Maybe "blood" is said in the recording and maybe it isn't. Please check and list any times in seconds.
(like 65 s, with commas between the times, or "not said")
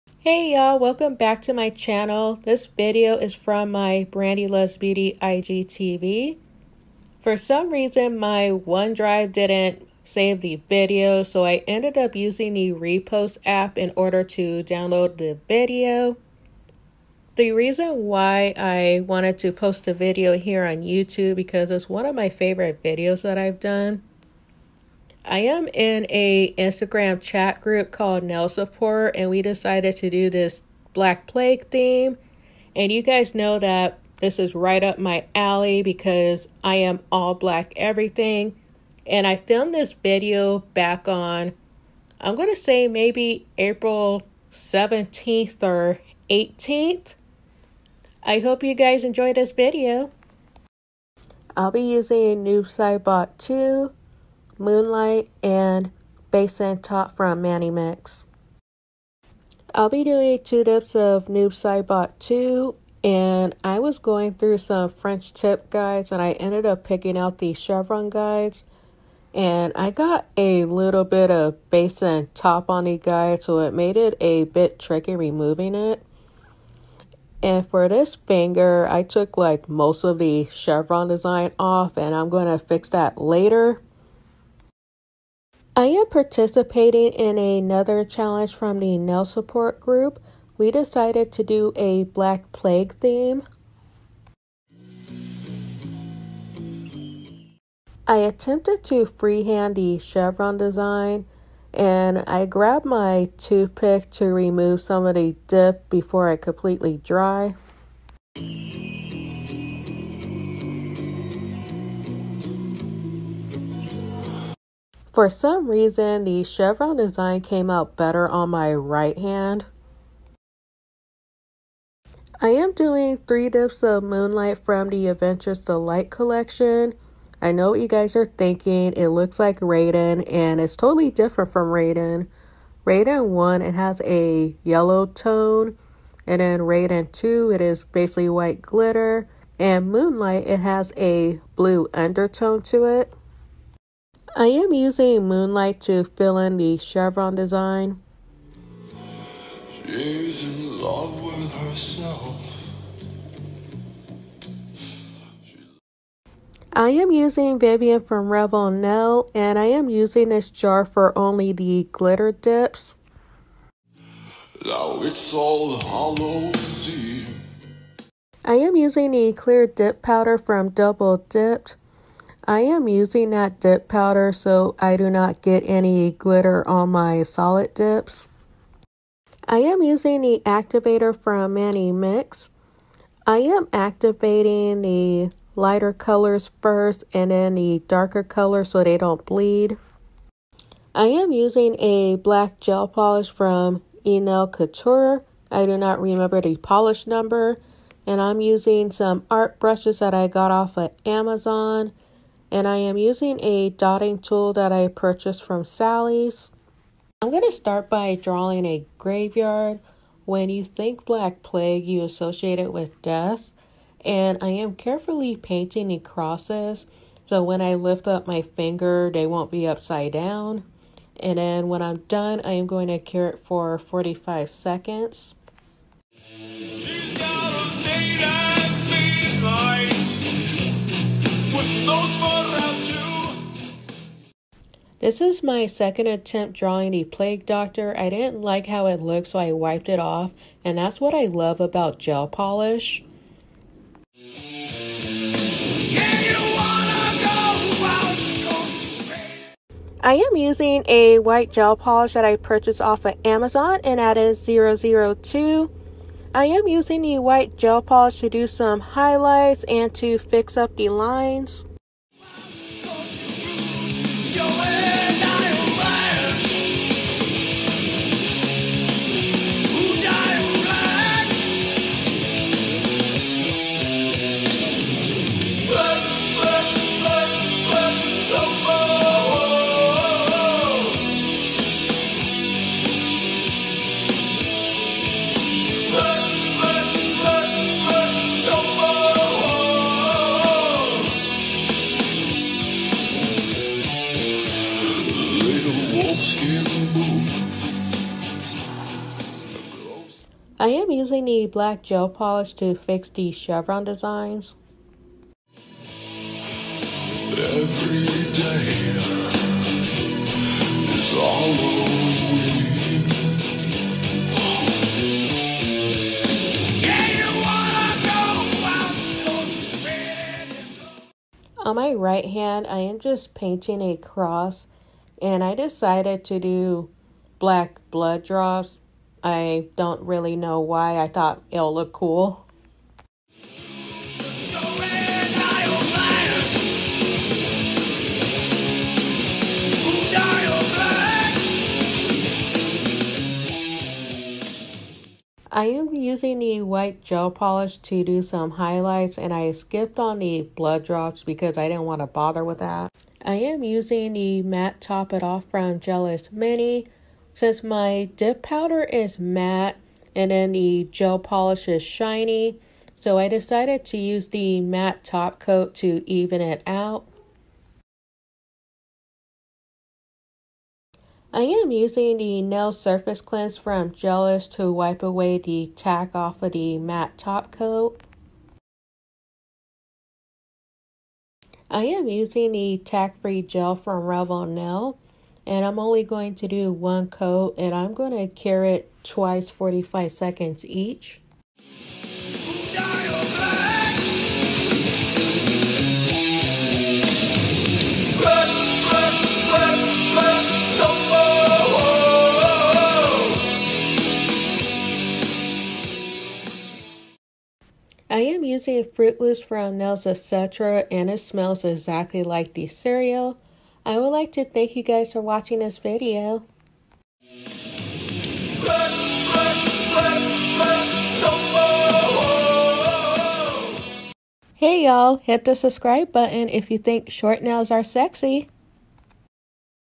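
327 s, 350 s.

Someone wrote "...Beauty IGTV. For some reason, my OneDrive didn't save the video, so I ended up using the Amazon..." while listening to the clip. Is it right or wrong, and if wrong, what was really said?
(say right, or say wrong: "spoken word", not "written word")
wrong: "Repost", not "Amazon".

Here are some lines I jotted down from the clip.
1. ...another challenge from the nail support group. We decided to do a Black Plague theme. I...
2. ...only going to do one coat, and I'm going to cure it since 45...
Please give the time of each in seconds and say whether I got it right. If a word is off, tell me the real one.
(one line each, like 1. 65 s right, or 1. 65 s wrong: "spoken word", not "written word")
1. 87 s right
2. 385 s wrong: "twice", not "since".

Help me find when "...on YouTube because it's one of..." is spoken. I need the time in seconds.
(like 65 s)
20 s.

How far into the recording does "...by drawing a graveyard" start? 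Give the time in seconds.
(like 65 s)
207 s.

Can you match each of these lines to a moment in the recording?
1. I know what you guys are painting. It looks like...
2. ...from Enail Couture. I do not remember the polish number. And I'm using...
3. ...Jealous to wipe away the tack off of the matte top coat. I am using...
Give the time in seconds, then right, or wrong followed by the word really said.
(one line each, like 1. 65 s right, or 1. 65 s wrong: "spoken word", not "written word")
1. 127 s wrong: "thinking", not "painting"
2. 193 s right
3. 373 s right.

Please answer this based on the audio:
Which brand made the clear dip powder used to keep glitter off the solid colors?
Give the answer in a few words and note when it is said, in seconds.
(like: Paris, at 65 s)
Double Dipped, at 170 s.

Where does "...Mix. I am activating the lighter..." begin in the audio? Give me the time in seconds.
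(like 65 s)
181 s.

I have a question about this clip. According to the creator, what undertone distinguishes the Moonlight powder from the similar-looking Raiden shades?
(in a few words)
Blue.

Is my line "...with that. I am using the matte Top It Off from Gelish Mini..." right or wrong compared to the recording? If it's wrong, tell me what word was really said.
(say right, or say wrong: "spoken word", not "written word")
right.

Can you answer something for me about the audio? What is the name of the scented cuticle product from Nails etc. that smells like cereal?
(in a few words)
Fruit Loops.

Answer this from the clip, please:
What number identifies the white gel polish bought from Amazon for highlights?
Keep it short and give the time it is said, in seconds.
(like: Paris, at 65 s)
002, at 254 s.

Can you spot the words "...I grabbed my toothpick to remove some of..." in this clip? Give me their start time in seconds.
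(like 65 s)
102 s.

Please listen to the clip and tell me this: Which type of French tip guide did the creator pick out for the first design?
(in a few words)
Chevron guides.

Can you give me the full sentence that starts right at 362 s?
So I decided to use the matte top coat to even it out.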